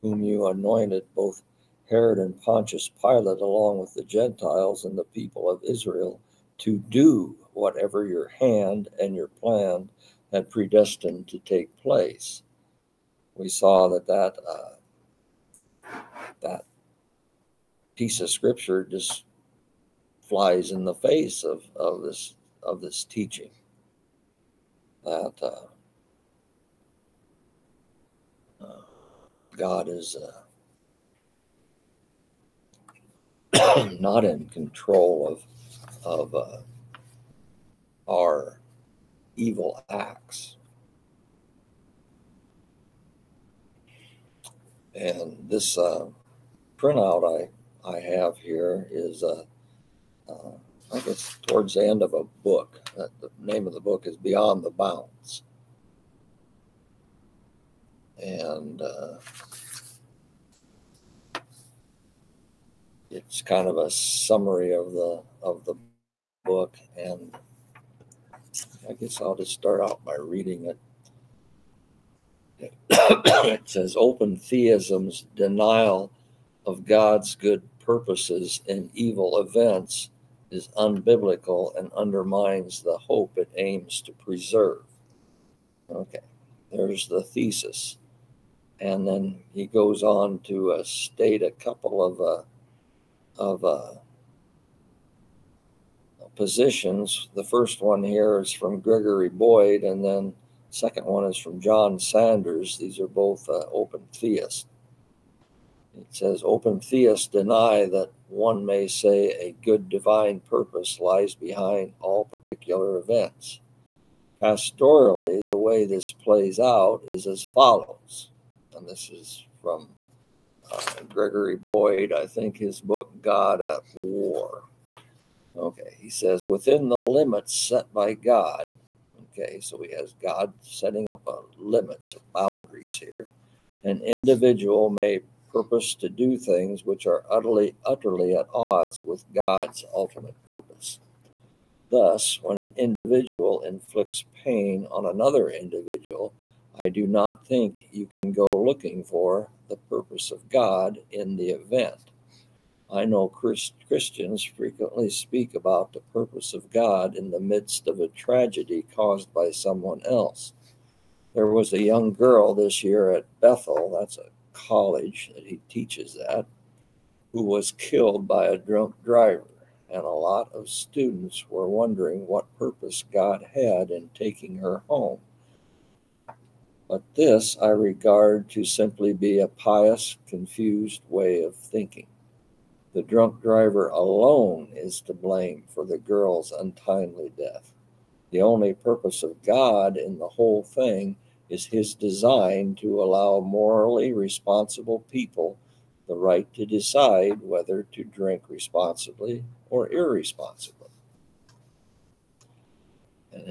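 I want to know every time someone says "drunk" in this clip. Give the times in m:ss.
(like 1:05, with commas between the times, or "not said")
2:48, 3:03.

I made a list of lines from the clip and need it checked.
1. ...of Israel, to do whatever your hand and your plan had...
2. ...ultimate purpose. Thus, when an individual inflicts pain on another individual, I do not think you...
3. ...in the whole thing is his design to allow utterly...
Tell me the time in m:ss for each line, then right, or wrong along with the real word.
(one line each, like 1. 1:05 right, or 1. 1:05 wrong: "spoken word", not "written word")
1. 0:05 right
2. 2:19 right
3. 3:09 wrong: "morally", not "utterly".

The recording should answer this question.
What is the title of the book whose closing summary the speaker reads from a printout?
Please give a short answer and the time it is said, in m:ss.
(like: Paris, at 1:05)
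Beyond the Bounds, at 0:54.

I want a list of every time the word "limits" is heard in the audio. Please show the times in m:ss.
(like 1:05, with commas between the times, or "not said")
2:06, 2:11.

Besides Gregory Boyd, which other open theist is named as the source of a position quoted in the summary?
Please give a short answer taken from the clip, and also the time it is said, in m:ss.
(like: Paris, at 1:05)
John Sanders, at 1:41.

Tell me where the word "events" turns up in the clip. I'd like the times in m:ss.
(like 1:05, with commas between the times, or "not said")
1:19, 1:52, 2:31.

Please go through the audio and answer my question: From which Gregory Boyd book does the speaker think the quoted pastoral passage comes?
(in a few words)
God at War.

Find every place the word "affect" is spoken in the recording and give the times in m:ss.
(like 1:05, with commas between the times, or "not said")
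not said.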